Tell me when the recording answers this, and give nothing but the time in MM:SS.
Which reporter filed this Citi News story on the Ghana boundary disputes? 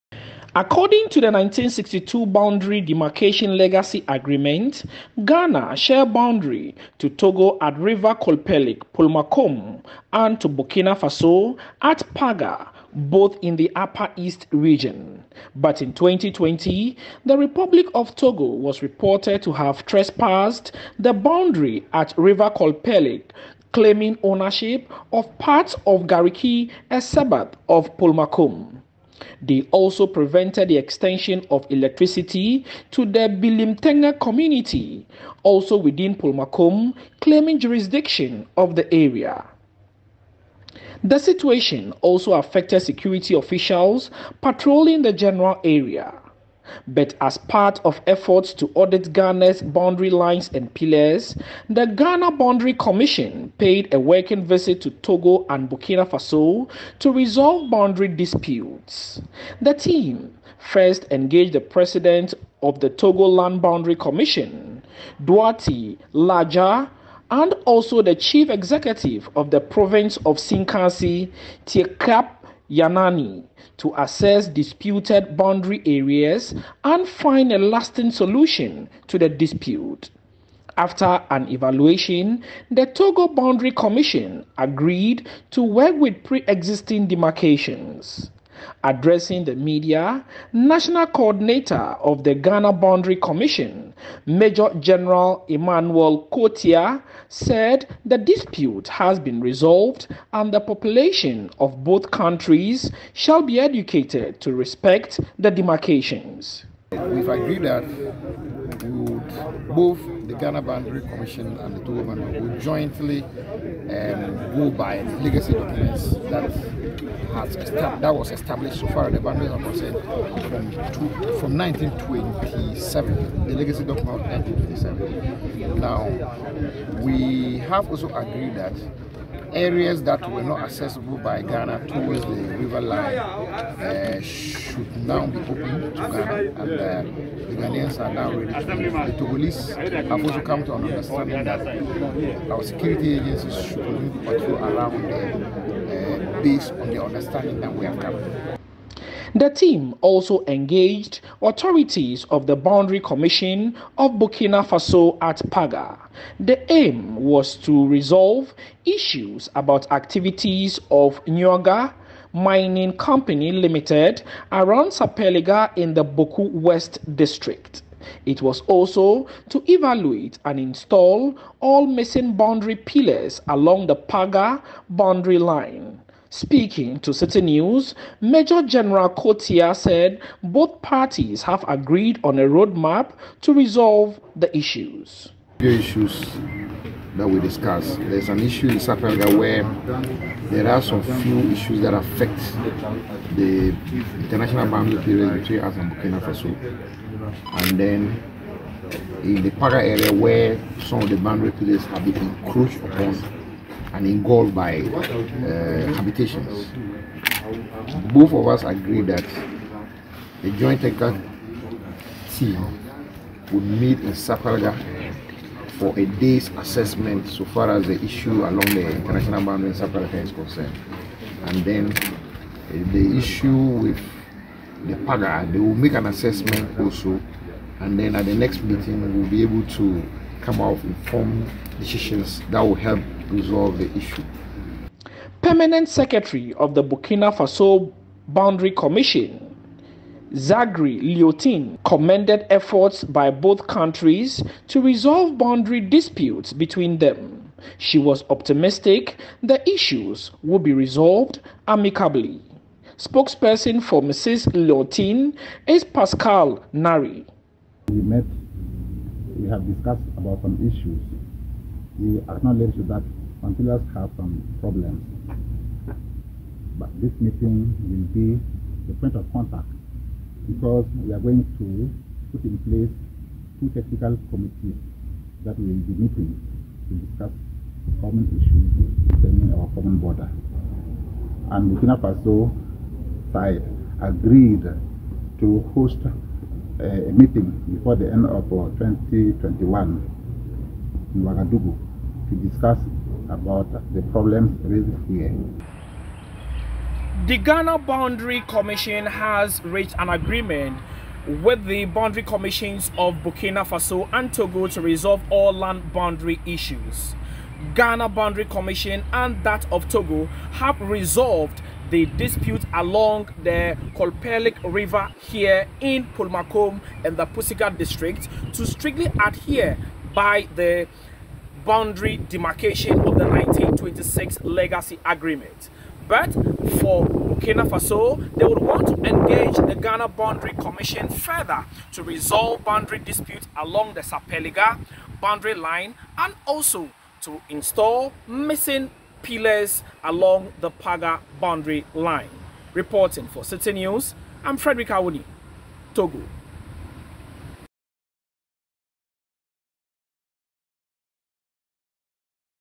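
05:44.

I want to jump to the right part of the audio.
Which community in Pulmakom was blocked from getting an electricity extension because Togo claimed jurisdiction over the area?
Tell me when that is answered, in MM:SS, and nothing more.
00:33.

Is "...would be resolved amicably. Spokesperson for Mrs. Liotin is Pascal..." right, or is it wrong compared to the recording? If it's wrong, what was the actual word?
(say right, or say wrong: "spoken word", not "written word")
right.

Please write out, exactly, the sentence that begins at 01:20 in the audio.
After an evaluation, the Togo Boundary Commission agreed to work with pre existing demarcations.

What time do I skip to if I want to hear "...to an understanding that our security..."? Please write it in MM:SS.
02:20.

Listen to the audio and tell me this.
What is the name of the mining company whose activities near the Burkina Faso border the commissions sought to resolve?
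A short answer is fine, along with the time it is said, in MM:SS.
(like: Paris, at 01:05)
Nyoga Mining Company Limited, at 02:41.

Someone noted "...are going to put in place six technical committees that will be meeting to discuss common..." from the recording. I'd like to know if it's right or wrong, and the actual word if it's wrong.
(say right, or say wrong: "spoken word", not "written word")
wrong: "two", not "six".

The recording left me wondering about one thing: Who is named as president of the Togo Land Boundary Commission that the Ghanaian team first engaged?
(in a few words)
Duarte Laja.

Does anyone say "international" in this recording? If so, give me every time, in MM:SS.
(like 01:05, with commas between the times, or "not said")
03:14, 03:38.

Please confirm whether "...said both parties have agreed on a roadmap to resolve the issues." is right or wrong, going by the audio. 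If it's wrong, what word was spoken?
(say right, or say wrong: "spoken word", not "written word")
right.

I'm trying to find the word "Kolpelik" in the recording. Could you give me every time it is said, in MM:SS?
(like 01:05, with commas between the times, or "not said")
00:08, 00:22, 05:13.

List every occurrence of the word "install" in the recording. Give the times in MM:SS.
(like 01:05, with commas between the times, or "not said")
02:50, 05:37.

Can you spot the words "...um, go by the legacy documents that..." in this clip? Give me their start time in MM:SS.
01:53.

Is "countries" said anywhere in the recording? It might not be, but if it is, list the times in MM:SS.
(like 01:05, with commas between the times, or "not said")
01:42, 04:03.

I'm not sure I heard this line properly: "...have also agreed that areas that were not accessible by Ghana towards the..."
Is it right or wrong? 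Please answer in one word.
right.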